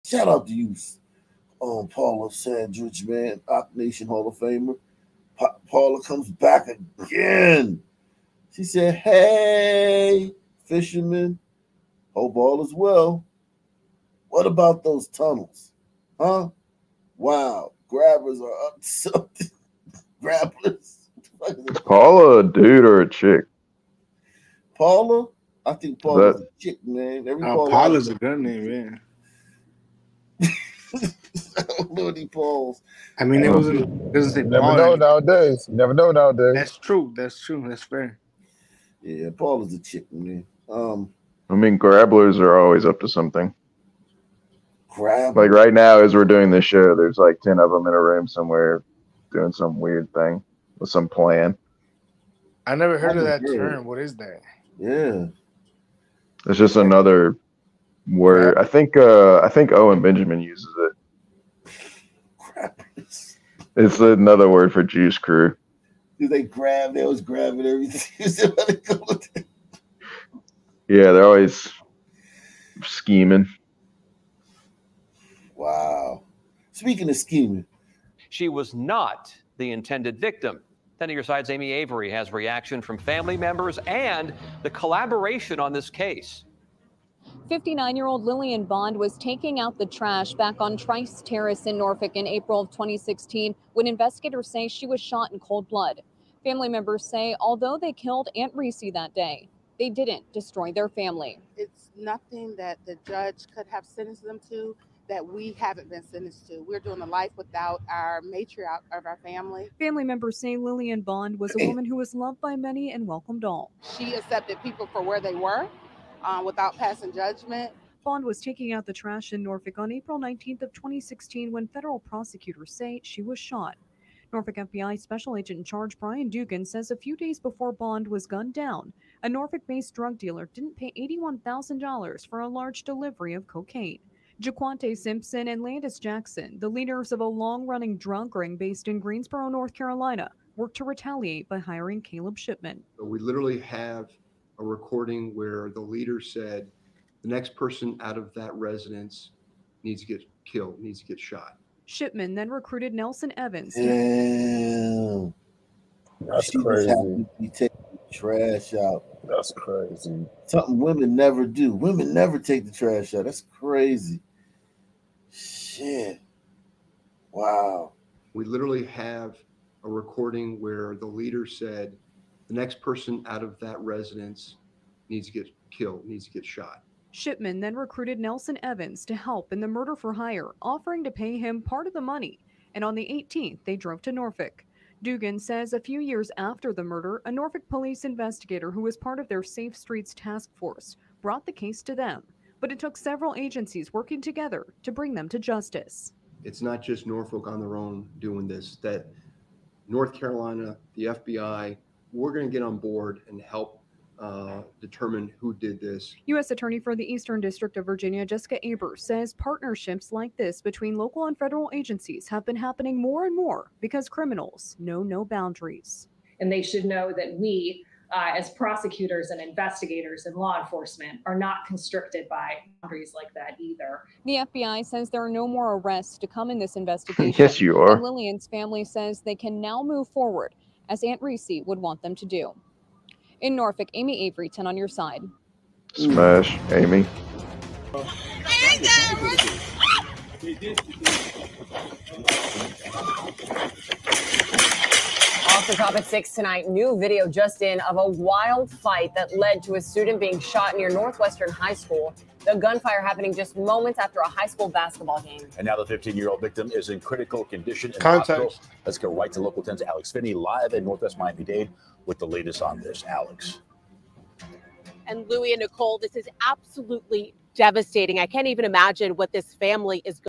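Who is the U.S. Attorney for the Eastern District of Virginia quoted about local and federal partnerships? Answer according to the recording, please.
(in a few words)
Jessica Abers.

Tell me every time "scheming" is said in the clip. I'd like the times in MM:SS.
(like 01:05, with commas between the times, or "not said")
01:12, 01:17.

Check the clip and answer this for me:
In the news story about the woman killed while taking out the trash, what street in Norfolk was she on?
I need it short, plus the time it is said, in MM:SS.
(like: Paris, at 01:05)
Trice Terrace, at 01:30.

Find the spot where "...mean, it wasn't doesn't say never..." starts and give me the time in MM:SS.
00:33.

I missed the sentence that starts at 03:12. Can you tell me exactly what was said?
But it took several agencies working together to bring them to justice.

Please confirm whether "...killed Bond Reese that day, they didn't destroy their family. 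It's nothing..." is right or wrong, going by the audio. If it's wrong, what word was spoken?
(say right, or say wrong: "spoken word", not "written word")
wrong: "Aunt", not "Bond".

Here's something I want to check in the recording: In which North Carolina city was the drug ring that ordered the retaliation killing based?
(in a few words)
Greensboro.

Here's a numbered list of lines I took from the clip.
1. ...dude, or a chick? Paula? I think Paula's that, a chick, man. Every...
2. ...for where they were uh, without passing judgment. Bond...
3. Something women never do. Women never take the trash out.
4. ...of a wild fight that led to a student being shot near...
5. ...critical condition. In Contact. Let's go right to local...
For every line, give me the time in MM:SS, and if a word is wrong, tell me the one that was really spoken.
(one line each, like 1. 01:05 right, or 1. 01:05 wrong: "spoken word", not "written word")
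1. 00:22 right
2. 01:54 right
3. 02:40 right
4. 04:07 right
5. 04:16 right.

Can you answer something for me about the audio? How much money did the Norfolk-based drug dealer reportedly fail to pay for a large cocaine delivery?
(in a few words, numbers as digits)
$81,000.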